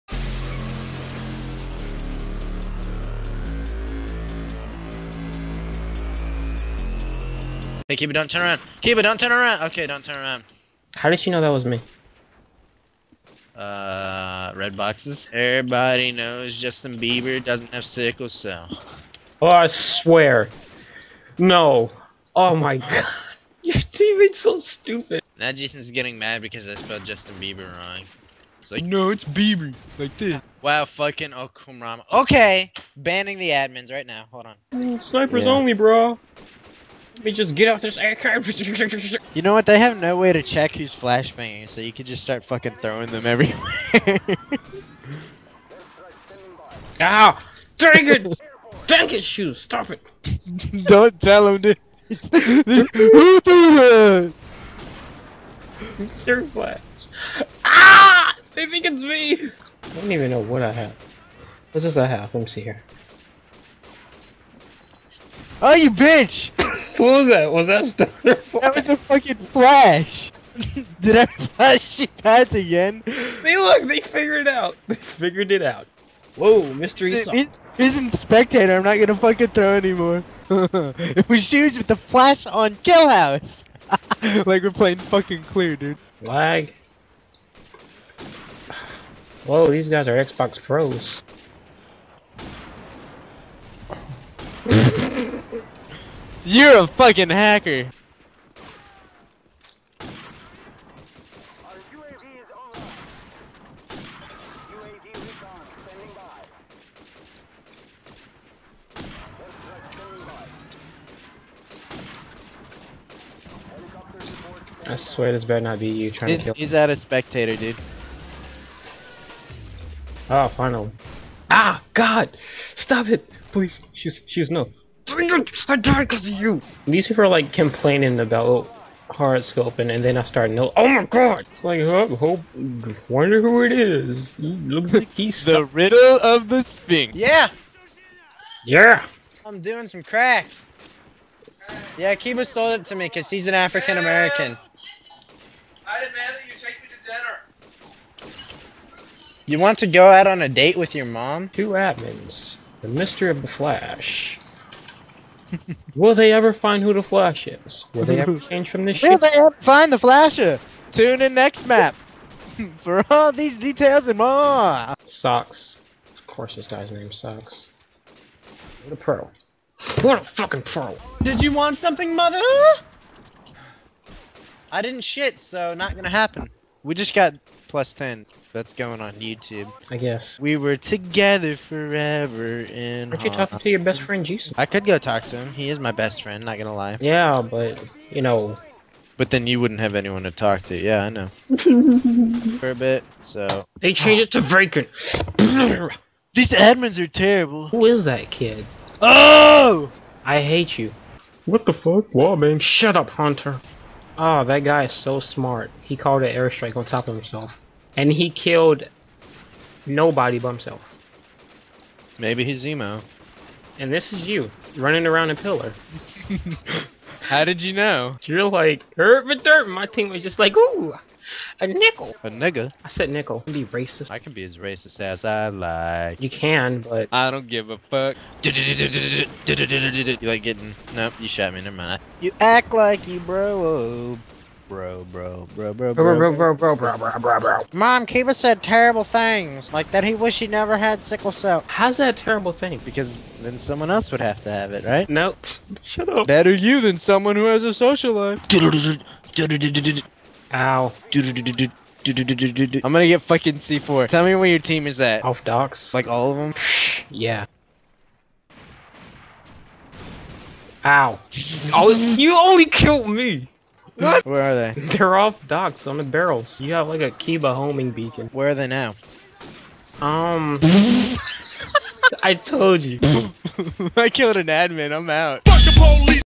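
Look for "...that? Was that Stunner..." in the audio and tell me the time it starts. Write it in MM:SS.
01:07.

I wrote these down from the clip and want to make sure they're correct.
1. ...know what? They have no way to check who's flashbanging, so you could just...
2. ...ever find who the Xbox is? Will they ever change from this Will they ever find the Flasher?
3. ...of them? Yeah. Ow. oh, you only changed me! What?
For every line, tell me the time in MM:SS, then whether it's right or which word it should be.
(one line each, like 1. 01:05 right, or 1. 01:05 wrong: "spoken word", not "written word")
1. 00:39 right
2. 02:36 wrong: "Flash", not "Xbox"
3. 04:16 wrong: "killed", not "changed".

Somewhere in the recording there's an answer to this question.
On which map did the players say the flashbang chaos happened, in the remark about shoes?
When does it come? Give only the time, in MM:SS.
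01:22.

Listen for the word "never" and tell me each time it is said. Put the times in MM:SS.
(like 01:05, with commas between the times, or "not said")
03:51, 04:00.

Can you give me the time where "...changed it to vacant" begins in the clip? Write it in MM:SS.
03:13.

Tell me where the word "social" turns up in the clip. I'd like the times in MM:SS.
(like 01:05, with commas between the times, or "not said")
04:07.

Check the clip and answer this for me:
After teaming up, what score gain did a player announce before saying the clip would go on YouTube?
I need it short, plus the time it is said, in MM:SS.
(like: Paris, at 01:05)
+10, at 02:57.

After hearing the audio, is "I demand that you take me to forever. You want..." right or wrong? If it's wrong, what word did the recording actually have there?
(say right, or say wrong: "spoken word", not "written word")
wrong: "dinner", not "forever".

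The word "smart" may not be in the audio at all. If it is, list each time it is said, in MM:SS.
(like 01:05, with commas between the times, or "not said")
03:25.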